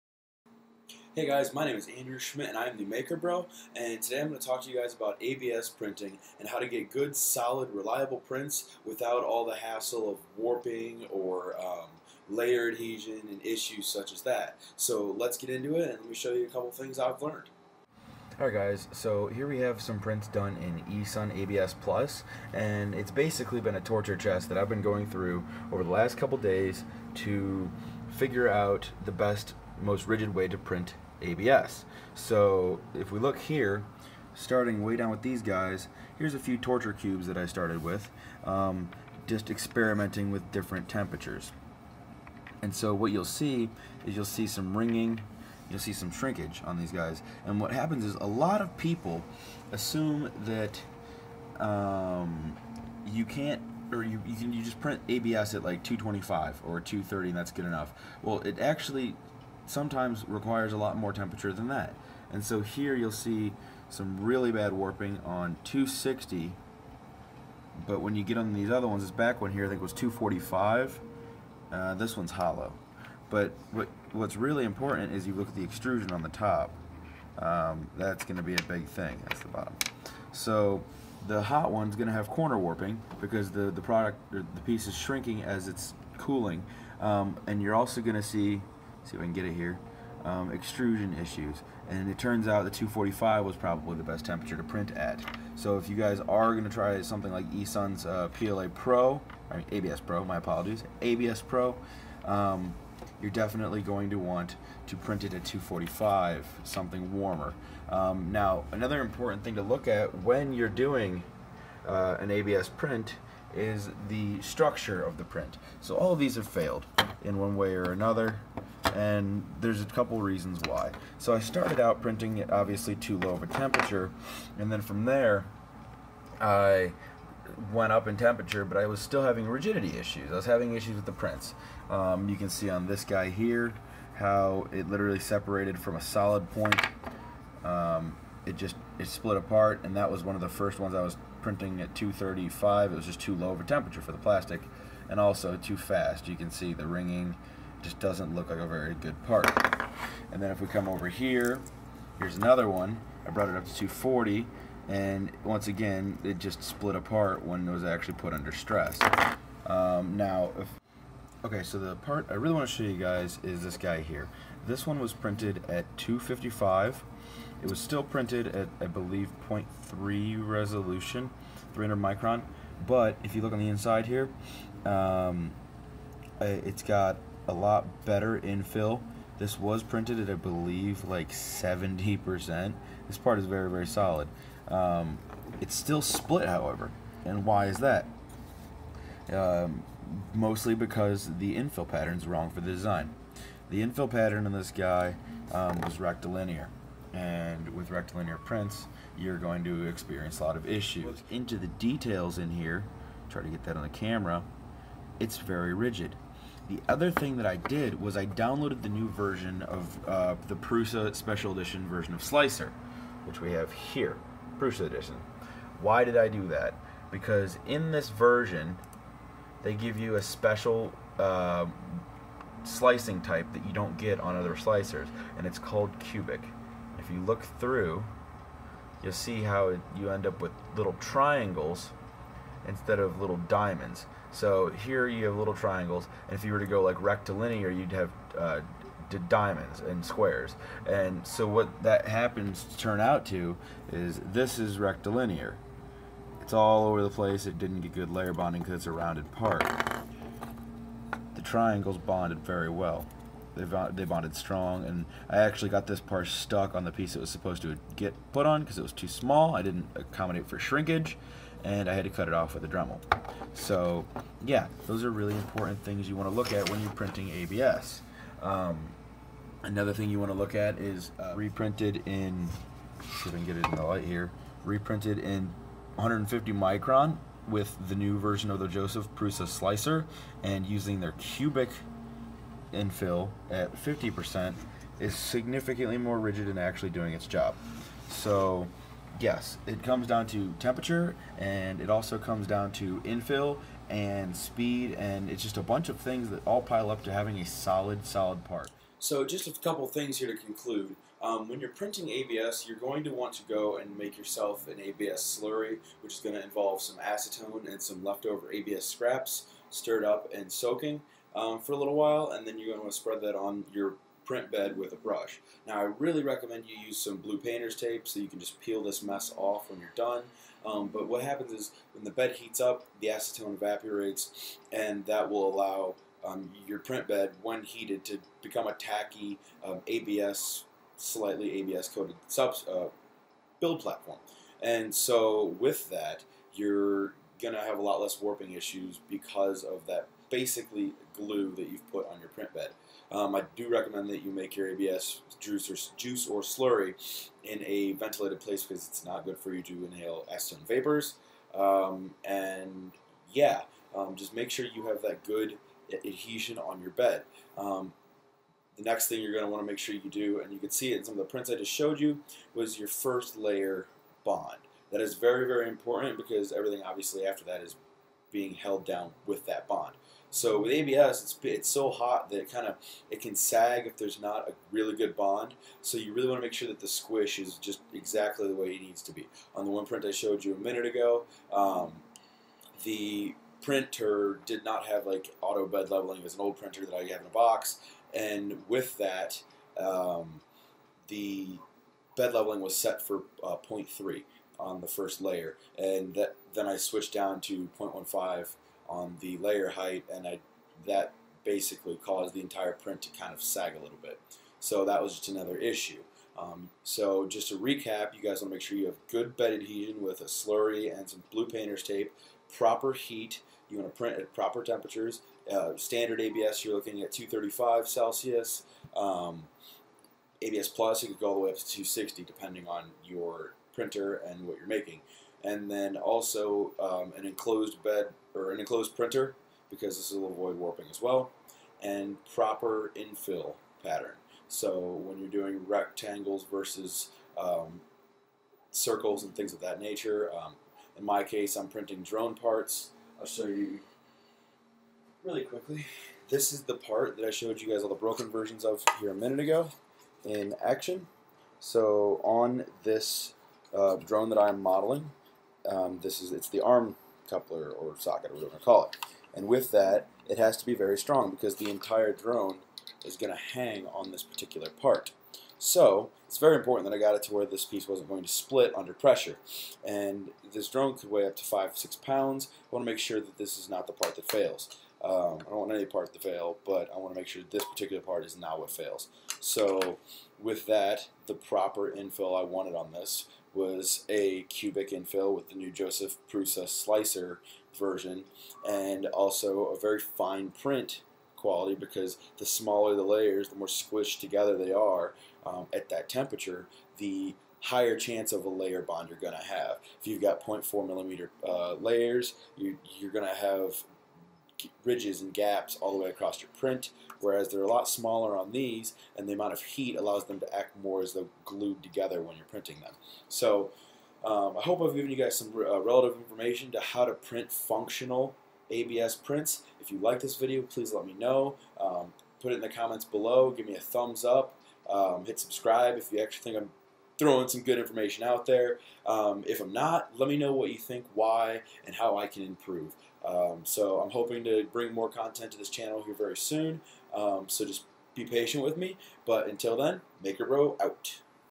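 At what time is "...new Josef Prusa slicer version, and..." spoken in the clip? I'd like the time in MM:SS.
08:05.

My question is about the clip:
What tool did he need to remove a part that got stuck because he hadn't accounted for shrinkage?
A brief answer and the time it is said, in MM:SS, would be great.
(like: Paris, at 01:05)
Dremel, at 04:22.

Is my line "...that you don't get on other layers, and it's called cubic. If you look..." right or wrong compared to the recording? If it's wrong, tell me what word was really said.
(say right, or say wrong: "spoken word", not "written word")
wrong: "slicers", not "layers".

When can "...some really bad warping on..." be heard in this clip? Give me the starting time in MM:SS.
01:03.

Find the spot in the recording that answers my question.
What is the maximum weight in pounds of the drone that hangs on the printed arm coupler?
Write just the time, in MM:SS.
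07:51.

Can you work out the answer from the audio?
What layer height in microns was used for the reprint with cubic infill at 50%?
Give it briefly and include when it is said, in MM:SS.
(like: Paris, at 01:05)
150 micron, at 04:35.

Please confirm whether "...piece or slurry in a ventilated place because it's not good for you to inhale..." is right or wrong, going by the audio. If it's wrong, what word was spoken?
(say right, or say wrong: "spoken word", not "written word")
wrong: "juice", not "piece".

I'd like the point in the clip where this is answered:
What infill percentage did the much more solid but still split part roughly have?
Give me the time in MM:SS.
03:01.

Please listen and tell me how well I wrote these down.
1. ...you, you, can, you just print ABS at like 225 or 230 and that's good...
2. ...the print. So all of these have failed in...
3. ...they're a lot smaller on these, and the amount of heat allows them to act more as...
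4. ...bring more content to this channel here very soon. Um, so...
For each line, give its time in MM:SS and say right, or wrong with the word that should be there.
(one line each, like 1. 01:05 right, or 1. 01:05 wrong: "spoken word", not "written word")
1. 00:54 right
2. 01:55 right
3. 08:27 right
4. 08:54 right.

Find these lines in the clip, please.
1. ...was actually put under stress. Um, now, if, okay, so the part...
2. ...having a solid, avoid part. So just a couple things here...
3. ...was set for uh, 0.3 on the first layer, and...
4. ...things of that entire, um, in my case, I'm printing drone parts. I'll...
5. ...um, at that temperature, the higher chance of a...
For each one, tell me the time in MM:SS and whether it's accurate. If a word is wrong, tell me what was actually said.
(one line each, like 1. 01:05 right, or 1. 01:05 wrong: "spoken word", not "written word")
1. 02:37 right
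2. 04:57 wrong: "solid", not "avoid"
3. 06:32 right
4. 07:19 wrong: "nature", not "entire"
5. 08:15 right.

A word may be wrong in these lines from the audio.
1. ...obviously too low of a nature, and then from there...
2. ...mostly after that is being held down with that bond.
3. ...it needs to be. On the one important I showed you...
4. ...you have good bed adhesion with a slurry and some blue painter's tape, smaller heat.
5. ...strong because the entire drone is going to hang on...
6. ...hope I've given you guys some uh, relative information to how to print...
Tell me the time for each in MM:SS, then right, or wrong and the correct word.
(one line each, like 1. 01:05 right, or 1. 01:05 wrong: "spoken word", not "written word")
1. 02:02 wrong: "temperature", not "nature"
2. 06:06 wrong: "obviously", not "mostly"
3. 06:18 wrong: "print", not "important"
4. 06:48 wrong: "proper", not "smaller"
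5. 07:40 right
6. 08:34 right.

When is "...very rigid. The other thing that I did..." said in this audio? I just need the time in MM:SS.
03:25.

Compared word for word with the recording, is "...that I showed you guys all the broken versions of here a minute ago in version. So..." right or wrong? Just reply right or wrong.
wrong.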